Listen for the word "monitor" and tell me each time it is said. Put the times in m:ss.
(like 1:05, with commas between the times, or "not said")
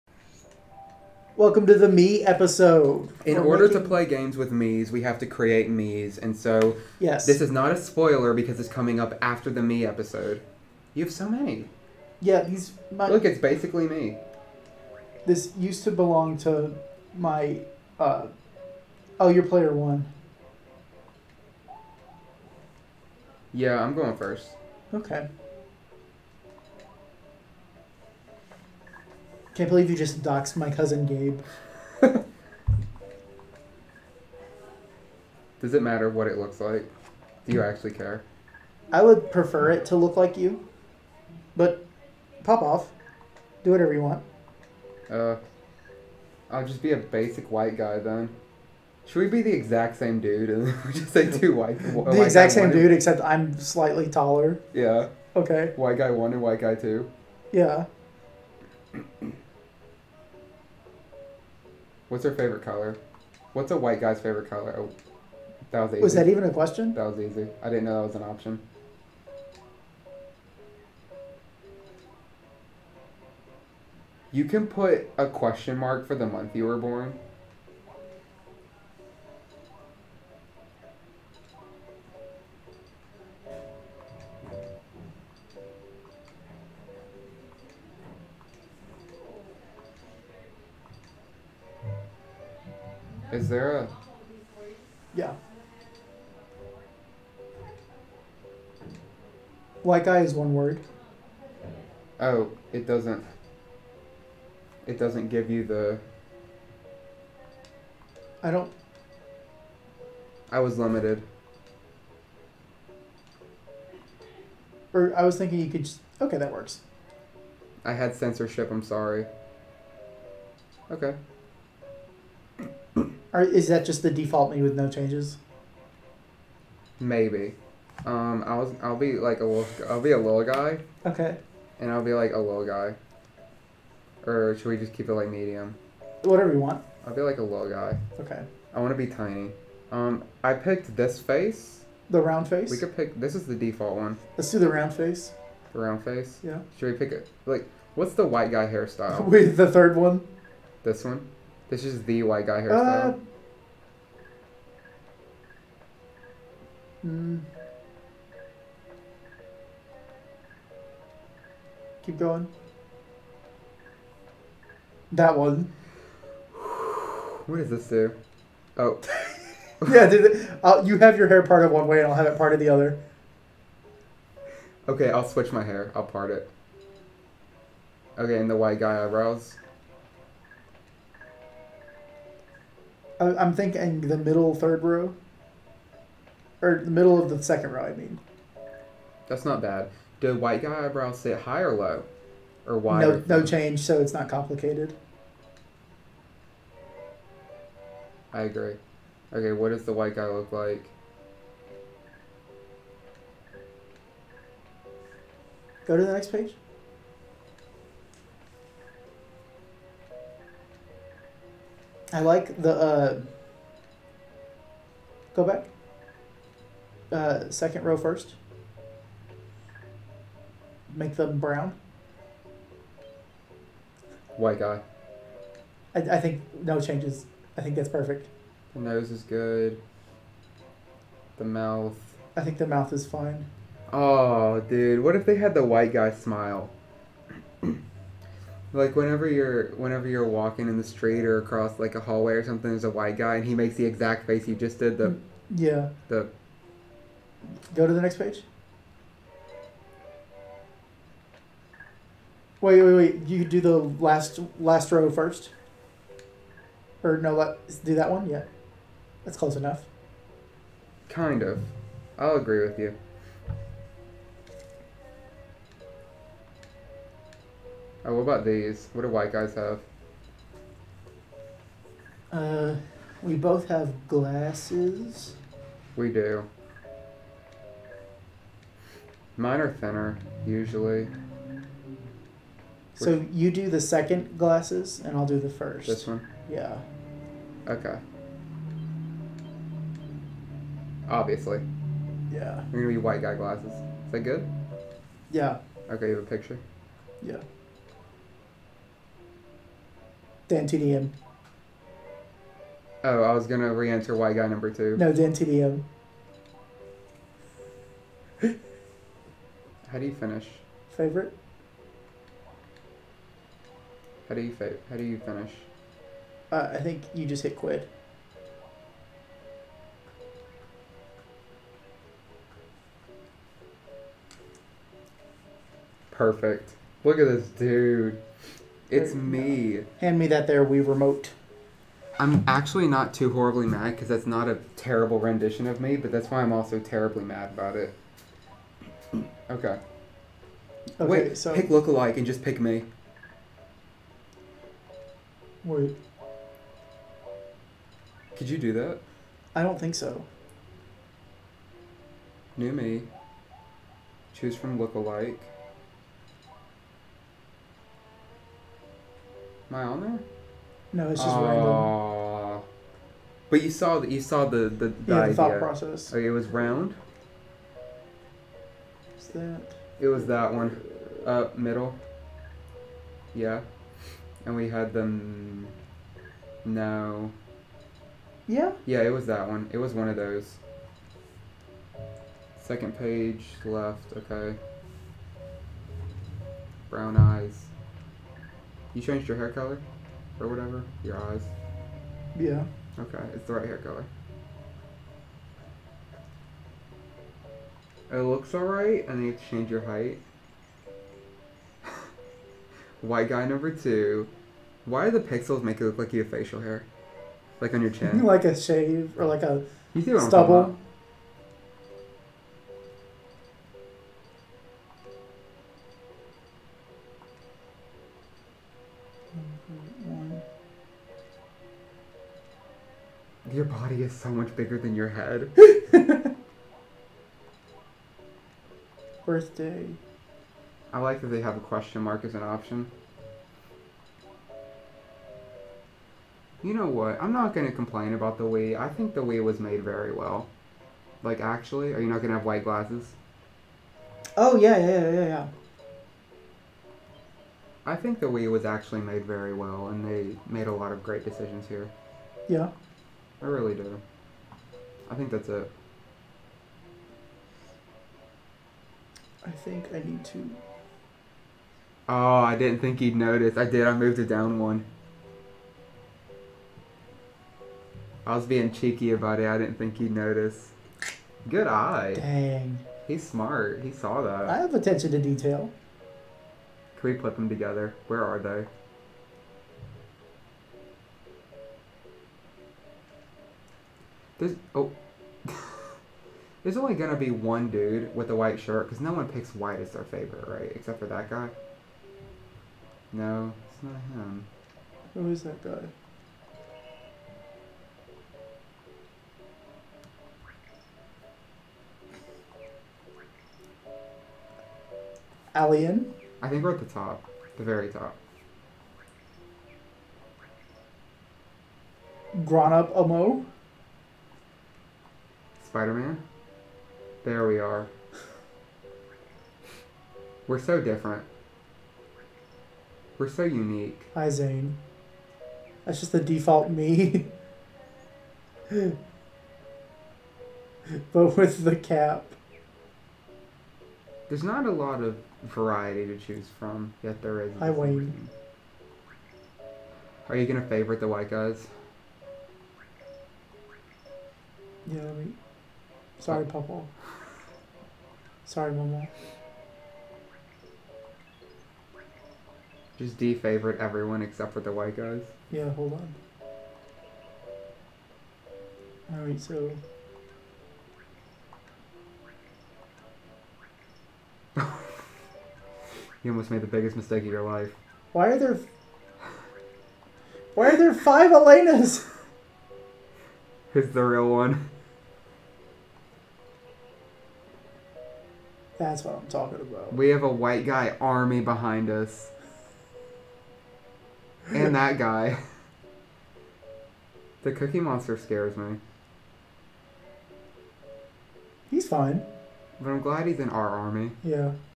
not said.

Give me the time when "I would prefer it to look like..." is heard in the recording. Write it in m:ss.
0:38.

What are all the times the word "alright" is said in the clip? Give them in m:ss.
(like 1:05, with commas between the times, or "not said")
6:38, 9:19.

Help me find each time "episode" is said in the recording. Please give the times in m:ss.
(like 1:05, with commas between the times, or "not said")
0:02, 0:09.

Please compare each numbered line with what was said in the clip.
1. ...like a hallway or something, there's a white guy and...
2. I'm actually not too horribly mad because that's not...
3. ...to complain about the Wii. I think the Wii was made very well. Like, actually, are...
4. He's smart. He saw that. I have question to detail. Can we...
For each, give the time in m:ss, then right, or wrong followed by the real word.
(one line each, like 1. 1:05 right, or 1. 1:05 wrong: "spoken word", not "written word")
1. 4:01 right
2. 5:32 right
3. 7:17 right
4. 7:53 wrong: "attention", not "question".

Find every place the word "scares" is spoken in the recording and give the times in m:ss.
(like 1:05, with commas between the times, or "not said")
9:48.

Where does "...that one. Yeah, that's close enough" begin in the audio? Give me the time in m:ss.
4:17.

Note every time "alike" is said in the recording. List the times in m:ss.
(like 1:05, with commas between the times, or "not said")
5:41, 5:54.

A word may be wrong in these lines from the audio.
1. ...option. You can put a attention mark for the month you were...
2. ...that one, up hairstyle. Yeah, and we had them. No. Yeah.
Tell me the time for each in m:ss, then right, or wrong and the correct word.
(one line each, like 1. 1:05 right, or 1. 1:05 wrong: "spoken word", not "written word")
1. 1:08 wrong: "question", not "attention"
2. 6:10 wrong: "middle", not "hairstyle".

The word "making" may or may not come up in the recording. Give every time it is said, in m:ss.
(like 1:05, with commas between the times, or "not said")
0:03.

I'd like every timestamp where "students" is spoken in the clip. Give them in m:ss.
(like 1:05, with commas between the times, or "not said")
not said.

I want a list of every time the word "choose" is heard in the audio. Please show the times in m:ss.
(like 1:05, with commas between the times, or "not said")
5:54, 8:56.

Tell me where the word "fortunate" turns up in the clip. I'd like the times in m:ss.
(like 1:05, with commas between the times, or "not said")
not said.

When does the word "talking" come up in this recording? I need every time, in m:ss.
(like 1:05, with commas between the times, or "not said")
9:39.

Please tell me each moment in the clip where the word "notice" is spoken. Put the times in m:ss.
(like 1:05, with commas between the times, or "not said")
7:43, 7:50.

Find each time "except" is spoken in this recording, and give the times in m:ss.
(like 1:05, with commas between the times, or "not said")
0:52, 8:10, 9:14.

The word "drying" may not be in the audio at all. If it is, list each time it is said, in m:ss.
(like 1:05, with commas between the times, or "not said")
not said.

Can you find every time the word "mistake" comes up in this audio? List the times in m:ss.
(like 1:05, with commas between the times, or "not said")
9:26.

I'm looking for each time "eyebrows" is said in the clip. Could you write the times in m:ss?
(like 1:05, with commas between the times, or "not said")
2:59, 3:10.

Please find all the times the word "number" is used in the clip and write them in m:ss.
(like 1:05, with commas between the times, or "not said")
5:04, 6:43.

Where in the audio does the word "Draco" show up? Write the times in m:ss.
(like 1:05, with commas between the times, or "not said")
not said.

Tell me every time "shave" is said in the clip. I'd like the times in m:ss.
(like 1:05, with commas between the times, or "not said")
6:48.